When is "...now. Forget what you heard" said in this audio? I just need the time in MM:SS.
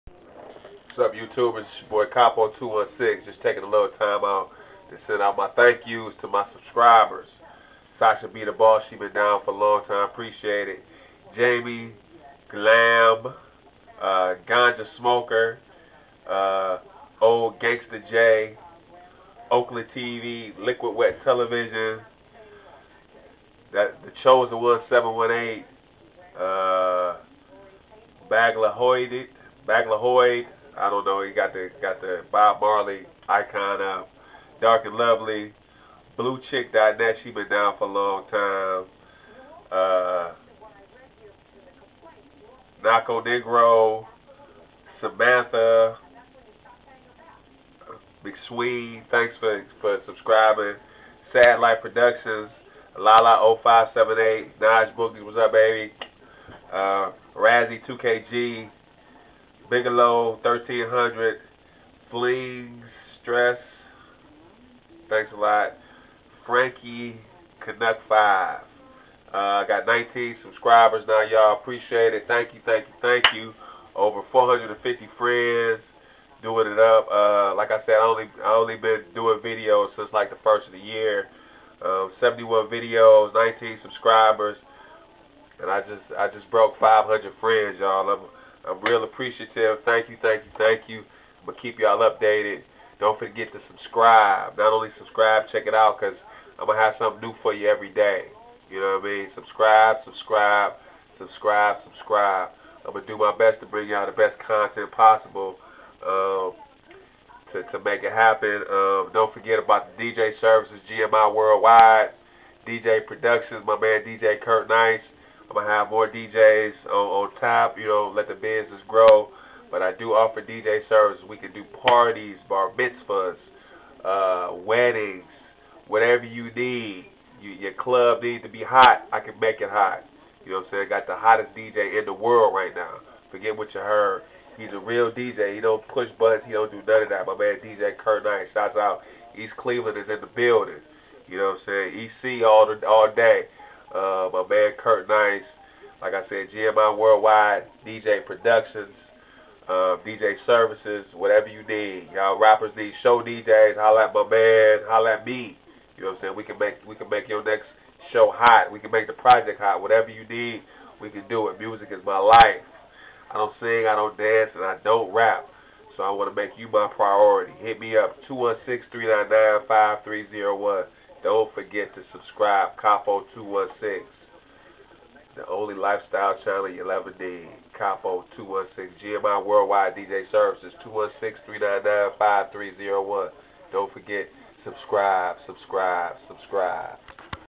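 02:12.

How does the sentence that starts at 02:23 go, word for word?
Uh, my man Kurt Nice, like I said, GMI Worldwide, DJ Productions, uh, DJ Services, whatever you need.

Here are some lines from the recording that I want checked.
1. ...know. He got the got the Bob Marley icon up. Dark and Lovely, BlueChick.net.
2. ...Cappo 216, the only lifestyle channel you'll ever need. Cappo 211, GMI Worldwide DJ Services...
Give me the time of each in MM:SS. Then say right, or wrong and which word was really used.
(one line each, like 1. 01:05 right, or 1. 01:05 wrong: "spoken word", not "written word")
1. 00:31 right
2. 02:52 wrong: "216", not "211".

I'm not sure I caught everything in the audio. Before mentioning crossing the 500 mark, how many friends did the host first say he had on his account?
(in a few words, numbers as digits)
Over 450.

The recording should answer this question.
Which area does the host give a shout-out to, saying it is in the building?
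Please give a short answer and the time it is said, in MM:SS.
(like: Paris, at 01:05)
East Cleveland, at 02:19.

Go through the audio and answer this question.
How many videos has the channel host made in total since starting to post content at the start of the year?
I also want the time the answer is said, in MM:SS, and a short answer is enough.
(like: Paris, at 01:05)
71, at 01:22.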